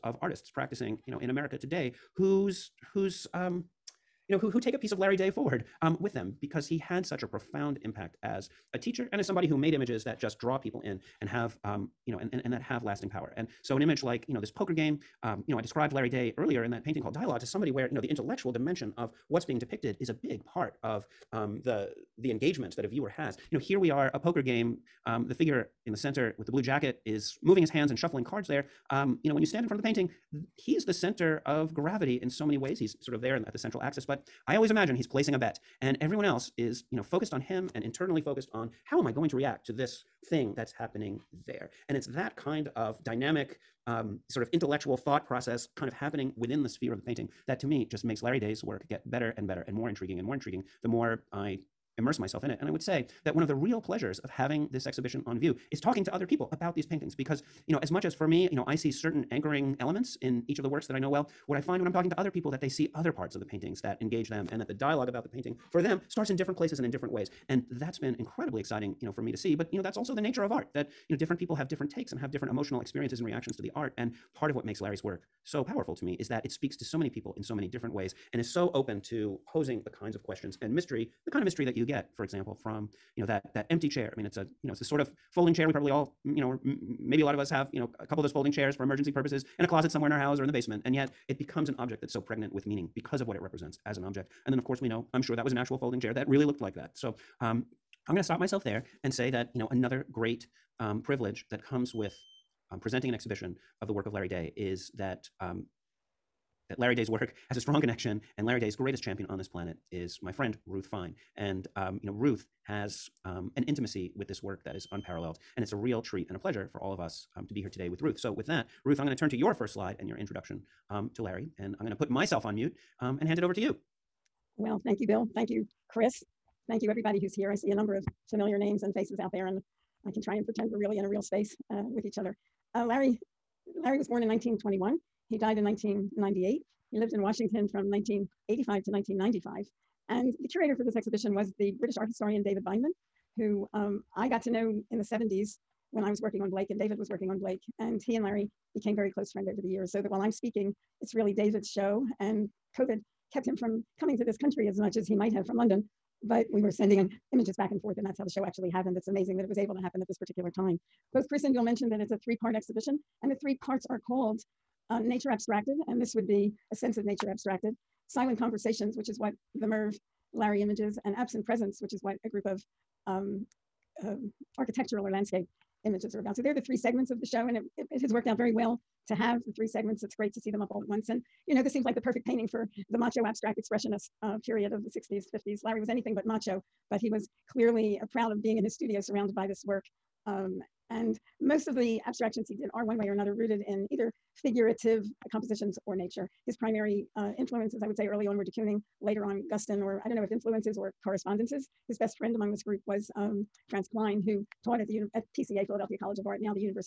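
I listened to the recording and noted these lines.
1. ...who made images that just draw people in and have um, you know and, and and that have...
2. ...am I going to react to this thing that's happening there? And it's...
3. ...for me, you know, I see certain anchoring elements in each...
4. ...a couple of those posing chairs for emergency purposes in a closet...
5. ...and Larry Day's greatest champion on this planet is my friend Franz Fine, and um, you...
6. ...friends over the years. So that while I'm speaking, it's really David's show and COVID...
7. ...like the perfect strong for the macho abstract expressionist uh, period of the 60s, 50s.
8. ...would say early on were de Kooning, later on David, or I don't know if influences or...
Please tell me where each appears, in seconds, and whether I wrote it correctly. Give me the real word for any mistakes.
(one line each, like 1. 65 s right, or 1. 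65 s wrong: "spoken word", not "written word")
1. 9 s right
2. 39 s right
3. 58 s right
4. 87 s wrong: "folding", not "posing"
5. 108 s wrong: "Ruth", not "Franz"
6. 149 s right
7. 181 s wrong: "painting", not "strong"
8. 197 s wrong: "Guston", not "David".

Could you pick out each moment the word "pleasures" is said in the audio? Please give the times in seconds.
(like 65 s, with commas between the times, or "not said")
53 s, 116 s.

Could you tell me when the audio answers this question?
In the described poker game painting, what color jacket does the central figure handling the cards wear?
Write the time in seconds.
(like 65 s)
26 s.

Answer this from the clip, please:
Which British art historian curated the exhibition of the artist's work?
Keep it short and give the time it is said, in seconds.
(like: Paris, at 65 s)
David Bindman, at 142 s.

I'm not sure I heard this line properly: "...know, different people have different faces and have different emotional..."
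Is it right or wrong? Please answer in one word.
wrong.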